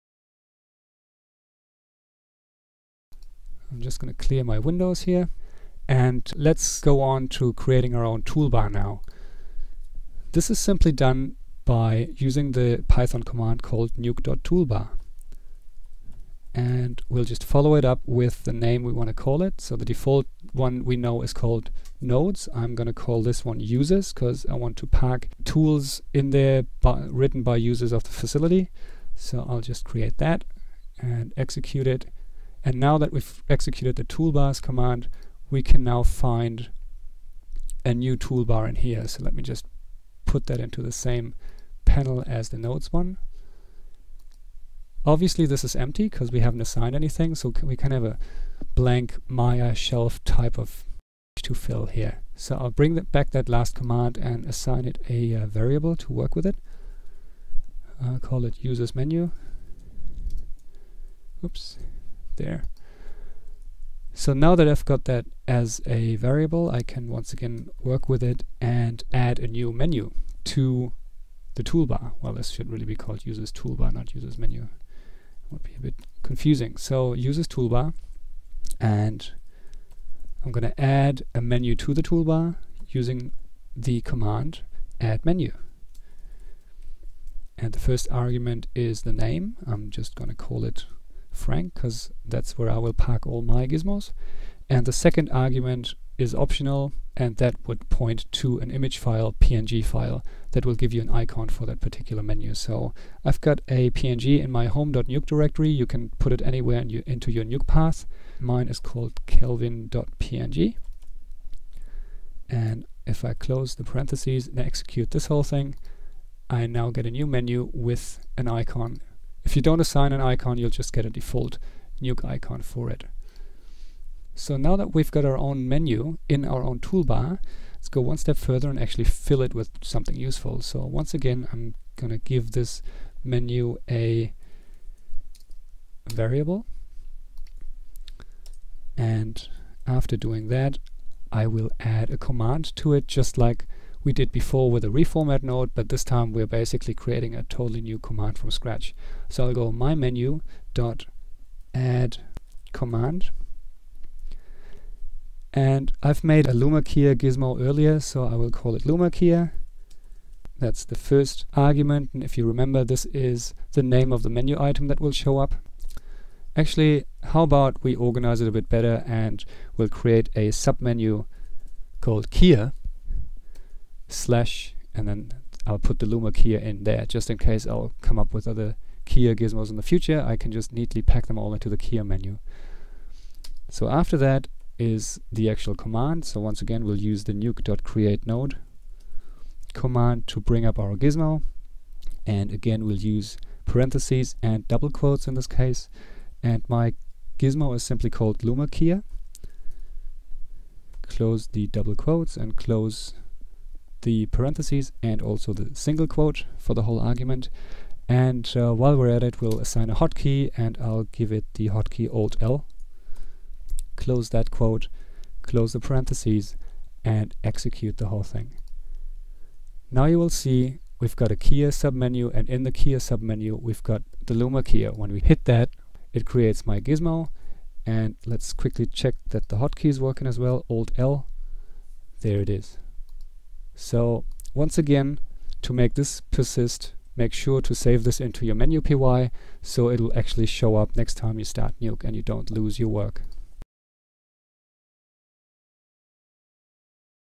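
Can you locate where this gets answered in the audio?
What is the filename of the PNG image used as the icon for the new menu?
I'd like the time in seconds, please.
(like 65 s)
109 s.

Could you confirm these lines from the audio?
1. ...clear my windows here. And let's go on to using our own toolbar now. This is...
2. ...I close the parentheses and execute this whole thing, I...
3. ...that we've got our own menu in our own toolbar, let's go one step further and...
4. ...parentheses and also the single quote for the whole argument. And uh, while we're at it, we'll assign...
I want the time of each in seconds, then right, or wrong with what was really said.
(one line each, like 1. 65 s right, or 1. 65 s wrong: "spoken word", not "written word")
1. 4 s wrong: "creating", not "using"
2. 113 s right
3. 124 s right
4. 204 s right.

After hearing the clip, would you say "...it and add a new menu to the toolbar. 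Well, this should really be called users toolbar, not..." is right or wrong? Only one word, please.
right.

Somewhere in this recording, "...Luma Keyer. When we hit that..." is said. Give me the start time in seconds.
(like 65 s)
224 s.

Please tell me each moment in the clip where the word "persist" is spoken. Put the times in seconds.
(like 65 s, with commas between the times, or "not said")
236 s.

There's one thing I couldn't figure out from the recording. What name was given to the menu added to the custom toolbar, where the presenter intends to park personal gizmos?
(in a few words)
frank.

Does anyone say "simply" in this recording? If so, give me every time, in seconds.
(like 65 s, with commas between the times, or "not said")
10 s, 197 s.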